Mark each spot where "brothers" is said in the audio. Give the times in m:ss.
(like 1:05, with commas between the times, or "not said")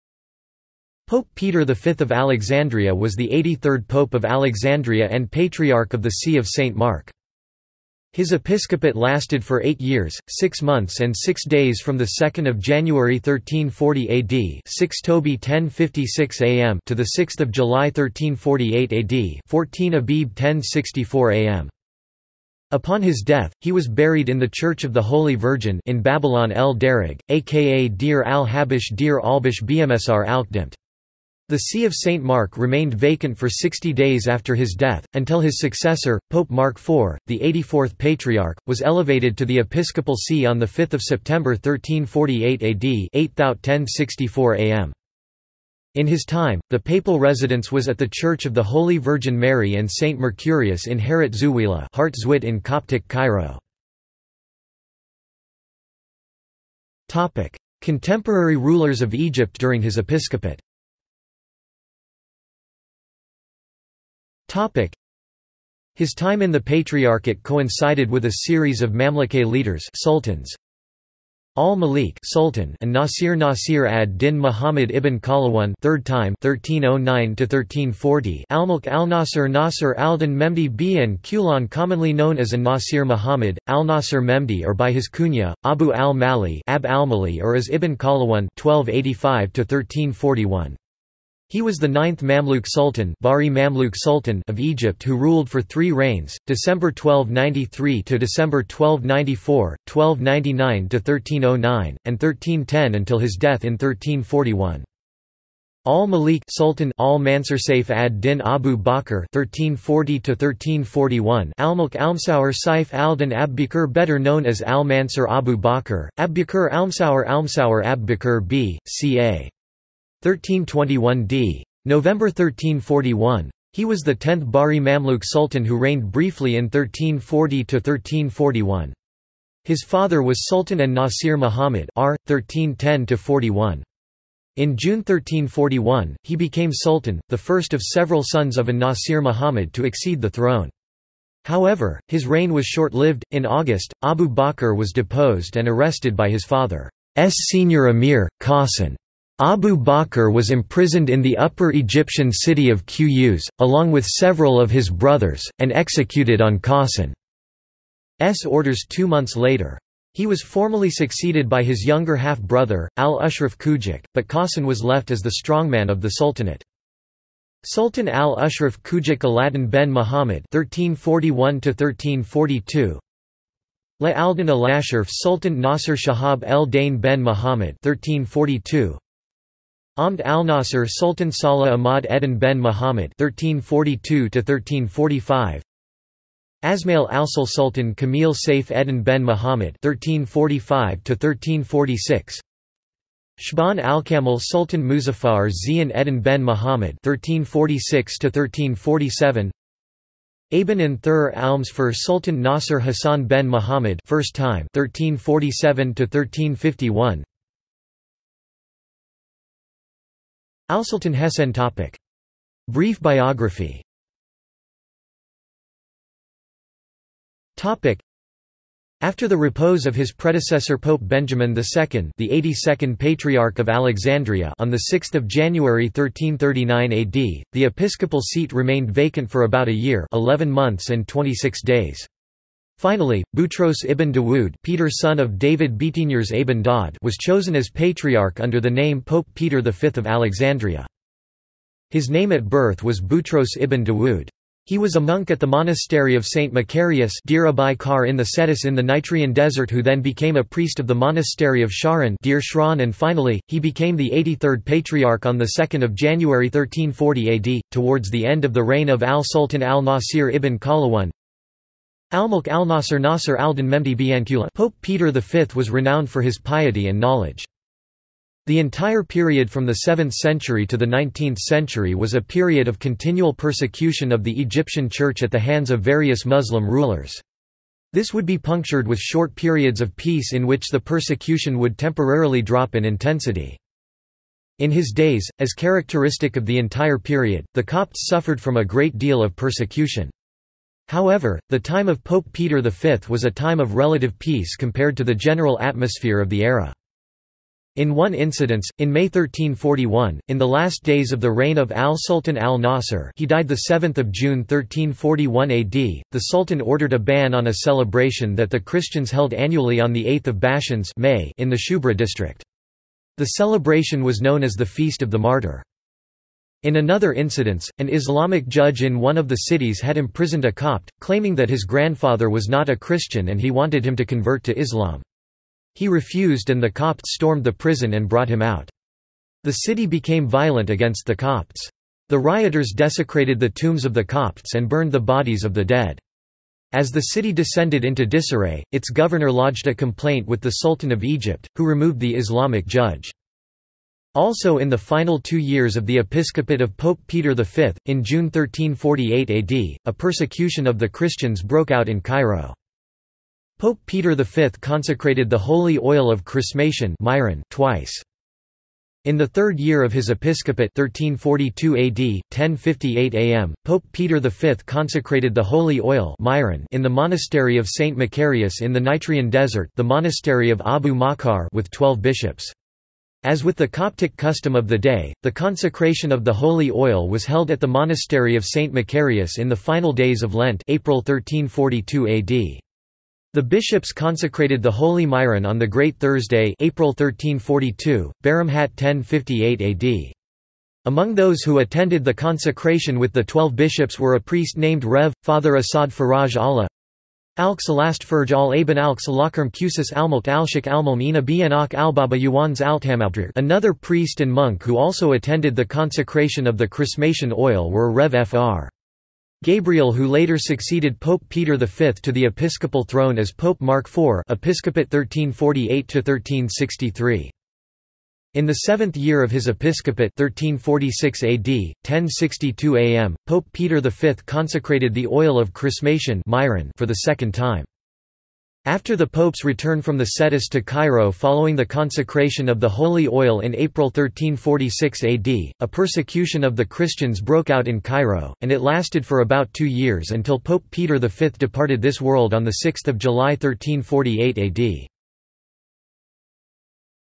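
2:34, 2:42.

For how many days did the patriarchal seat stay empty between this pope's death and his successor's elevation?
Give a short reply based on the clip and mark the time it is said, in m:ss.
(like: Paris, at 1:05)
60, at 0:33.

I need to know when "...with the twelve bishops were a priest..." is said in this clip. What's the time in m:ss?
6:32.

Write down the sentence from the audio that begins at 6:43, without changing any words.
Another priest and monk who also attended the consecration of the chrismation oil were Rev Fr.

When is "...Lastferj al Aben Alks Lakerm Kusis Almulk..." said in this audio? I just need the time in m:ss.
6:37.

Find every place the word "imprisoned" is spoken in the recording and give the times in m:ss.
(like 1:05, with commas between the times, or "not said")
2:30, 5:19.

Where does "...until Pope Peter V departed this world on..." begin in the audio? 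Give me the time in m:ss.
7:20.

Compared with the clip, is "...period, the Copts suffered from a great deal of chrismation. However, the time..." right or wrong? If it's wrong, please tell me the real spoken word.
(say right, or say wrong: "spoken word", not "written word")
wrong: "persecution", not "chrismation".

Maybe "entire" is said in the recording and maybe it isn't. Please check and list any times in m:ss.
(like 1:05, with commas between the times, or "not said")
4:28, 4:46.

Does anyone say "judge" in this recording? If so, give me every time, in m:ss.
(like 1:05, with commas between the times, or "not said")
5:18, 5:42.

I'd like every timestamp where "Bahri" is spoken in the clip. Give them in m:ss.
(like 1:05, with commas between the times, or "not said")
1:33, 2:04.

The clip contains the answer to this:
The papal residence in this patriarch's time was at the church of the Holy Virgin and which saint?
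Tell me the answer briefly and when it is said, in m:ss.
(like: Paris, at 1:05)
St. Mercurius, at 0:49.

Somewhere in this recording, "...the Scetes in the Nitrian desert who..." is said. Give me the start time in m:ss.
4:08.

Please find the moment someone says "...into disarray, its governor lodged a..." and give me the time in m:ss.
5:37.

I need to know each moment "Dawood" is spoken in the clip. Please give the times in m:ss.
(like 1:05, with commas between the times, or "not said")
3:54, 4:03.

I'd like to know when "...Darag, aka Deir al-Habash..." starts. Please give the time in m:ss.
0:26.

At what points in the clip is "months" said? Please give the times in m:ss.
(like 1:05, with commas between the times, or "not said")
0:10, 2:39, 3:50.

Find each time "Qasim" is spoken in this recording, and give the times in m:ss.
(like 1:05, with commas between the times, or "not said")
2:28, 2:36, 2:44.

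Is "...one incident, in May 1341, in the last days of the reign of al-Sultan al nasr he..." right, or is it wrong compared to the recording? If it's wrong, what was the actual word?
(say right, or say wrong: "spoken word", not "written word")
right.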